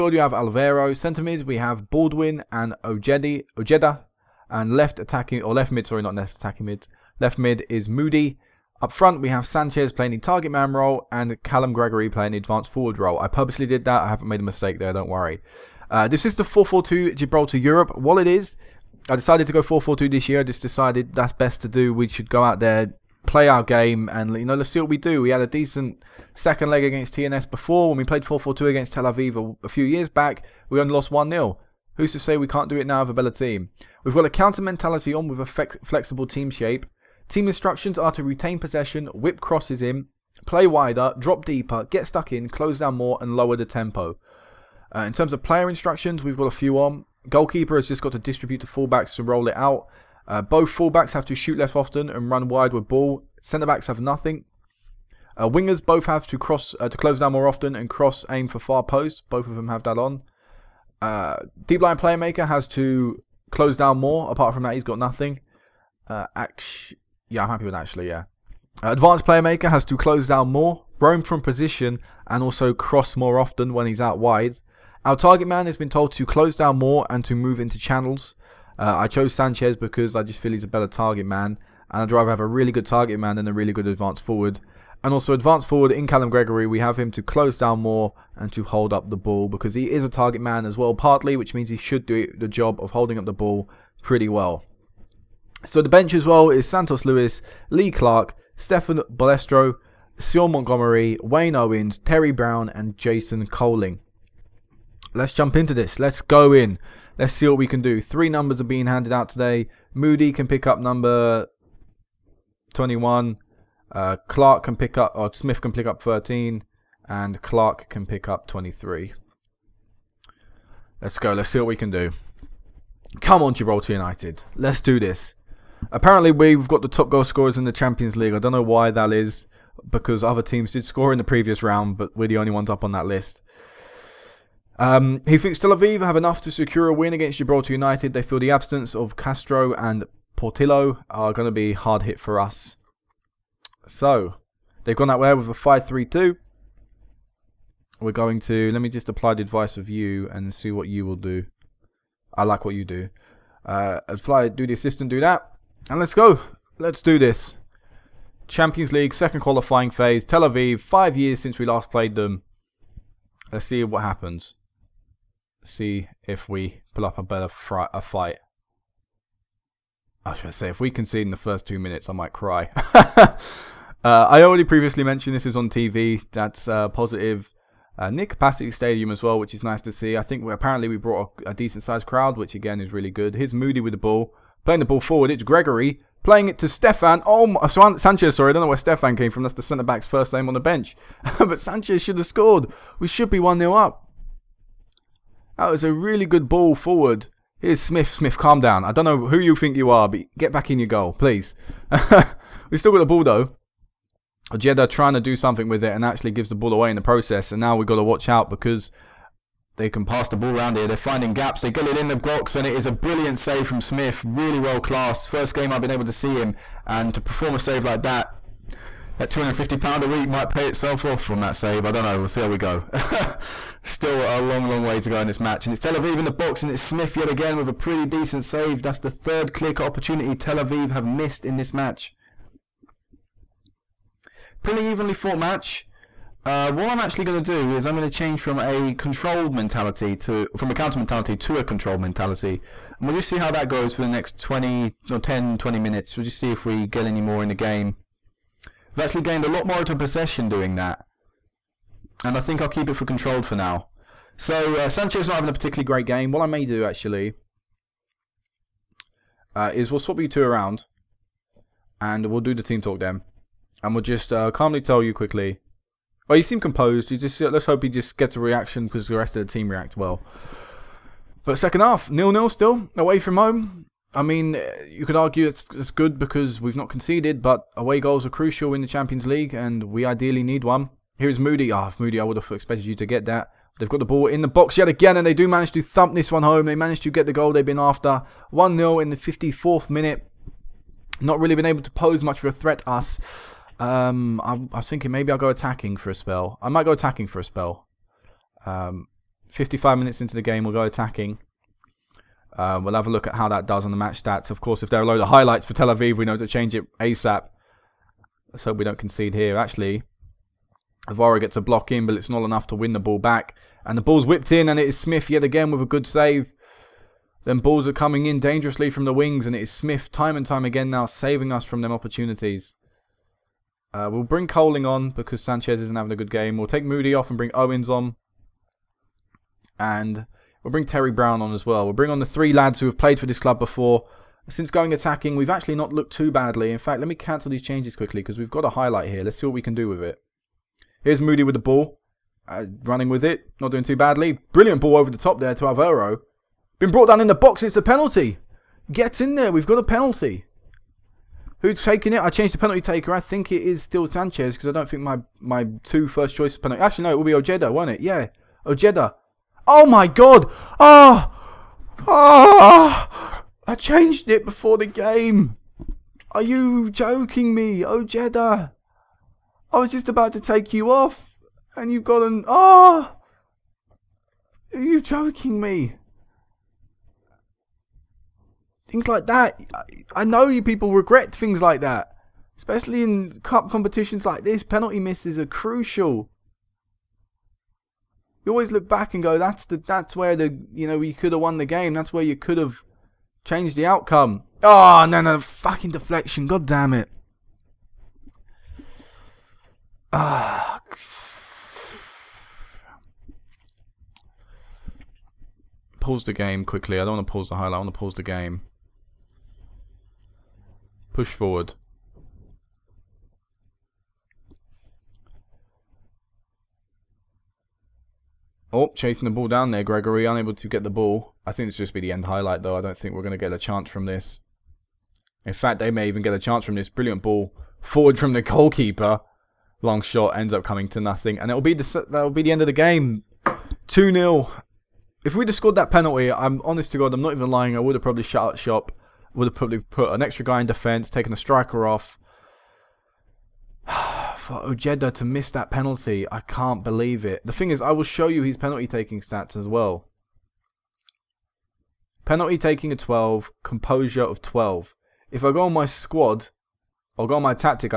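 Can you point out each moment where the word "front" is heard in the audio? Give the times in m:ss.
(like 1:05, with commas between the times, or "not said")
0:08.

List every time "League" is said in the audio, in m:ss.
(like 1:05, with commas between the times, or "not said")
2:08, 2:38, 4:39.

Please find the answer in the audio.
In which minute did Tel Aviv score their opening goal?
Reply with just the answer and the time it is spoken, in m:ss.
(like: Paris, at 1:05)
54th, at 4:49.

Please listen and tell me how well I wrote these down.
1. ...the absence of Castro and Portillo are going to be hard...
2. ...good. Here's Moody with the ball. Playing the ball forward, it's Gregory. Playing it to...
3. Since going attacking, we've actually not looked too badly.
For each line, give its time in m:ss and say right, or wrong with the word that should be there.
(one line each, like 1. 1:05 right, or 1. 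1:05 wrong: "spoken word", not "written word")
1. 2:18 right
2. 3:03 right
3. 5:34 right.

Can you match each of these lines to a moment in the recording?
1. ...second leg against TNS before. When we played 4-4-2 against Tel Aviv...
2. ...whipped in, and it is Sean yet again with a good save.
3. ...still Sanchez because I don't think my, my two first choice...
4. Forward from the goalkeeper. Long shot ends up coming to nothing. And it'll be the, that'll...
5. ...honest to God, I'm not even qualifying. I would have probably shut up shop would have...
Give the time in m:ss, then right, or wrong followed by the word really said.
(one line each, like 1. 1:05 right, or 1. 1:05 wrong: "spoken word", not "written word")
1. 0:26 right
2. 5:14 wrong: "Smith", not "Sean"
3. 5:53 right
4. 7:07 right
5. 7:16 wrong: "lying", not "qualifying".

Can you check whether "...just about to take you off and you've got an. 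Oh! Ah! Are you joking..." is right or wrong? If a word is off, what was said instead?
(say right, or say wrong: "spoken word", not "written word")
right.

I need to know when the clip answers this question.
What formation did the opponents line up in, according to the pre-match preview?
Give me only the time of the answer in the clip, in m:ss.
2:25.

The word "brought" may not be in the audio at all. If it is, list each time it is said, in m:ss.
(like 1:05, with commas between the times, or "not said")
3:00, 5:46.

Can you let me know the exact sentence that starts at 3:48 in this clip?
That's the third clear opportunity Tel Aviv have missed in this match.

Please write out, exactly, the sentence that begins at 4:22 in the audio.
And we'll do the team talk then.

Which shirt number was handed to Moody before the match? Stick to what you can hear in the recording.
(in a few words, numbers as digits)
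21.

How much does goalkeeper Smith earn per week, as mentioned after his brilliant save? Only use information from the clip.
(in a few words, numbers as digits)
250 pounds.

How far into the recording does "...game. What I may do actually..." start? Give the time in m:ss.
4:16.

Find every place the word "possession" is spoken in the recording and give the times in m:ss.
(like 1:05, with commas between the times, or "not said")
0:38, 4:09.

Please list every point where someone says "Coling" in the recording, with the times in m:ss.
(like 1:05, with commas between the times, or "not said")
1:43, 5:24.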